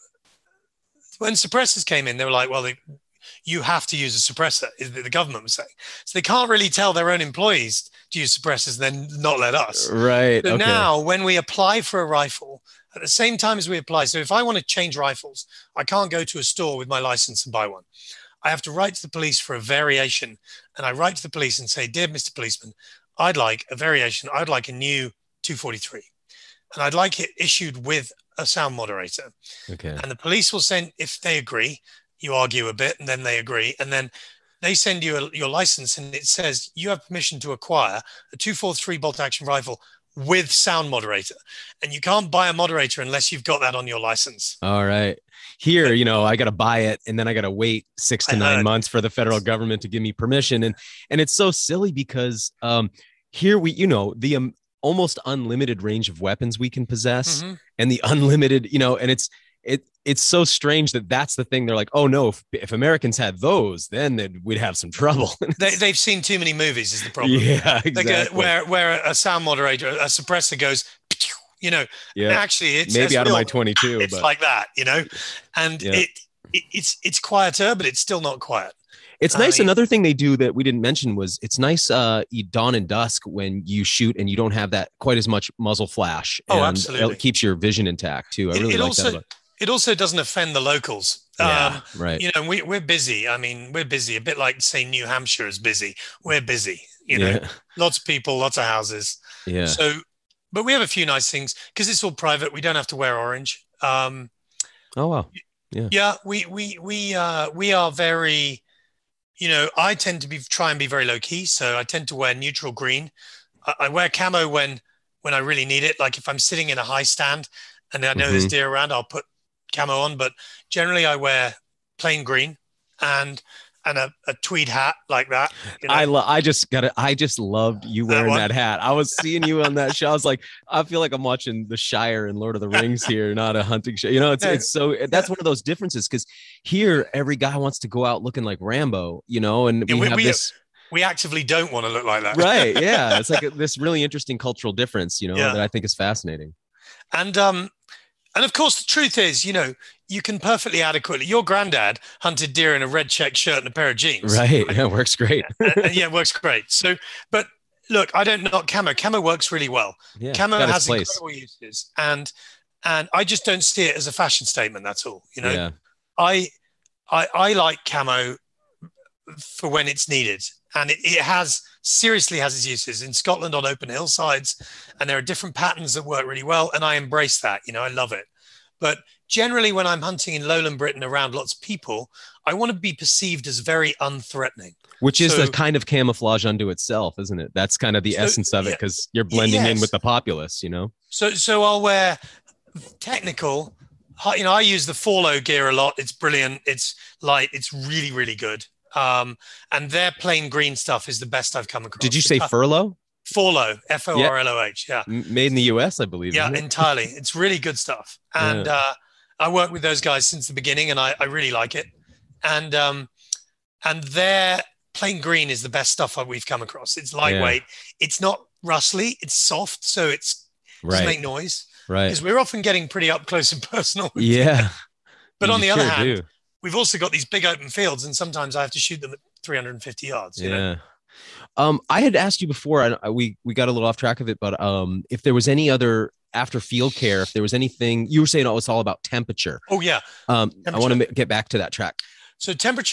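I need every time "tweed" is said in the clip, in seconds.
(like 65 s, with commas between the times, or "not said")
124 s.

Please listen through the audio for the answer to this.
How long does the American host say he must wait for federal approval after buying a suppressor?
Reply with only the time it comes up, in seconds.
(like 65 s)
47 s.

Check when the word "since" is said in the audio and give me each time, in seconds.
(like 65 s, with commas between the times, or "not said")
210 s.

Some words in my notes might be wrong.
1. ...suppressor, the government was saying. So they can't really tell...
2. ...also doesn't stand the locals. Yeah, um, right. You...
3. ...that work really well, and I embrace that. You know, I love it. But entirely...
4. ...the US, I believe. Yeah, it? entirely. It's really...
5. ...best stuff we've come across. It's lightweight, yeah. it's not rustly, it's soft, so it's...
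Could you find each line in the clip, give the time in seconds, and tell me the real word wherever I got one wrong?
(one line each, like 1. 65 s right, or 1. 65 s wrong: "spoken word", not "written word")
1. 4 s right
2. 89 s wrong: "offend", not "stand"
3. 175 s wrong: "generally", not "entirely"
4. 205 s right
5. 215 s right.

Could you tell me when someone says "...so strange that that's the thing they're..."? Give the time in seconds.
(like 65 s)
60 s.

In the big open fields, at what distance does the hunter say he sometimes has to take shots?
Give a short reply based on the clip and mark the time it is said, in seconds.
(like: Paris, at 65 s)
350 yards, at 229 s.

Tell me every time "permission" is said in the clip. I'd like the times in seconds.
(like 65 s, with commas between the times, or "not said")
37 s, 50 s.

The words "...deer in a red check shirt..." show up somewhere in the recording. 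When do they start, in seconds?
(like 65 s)
152 s.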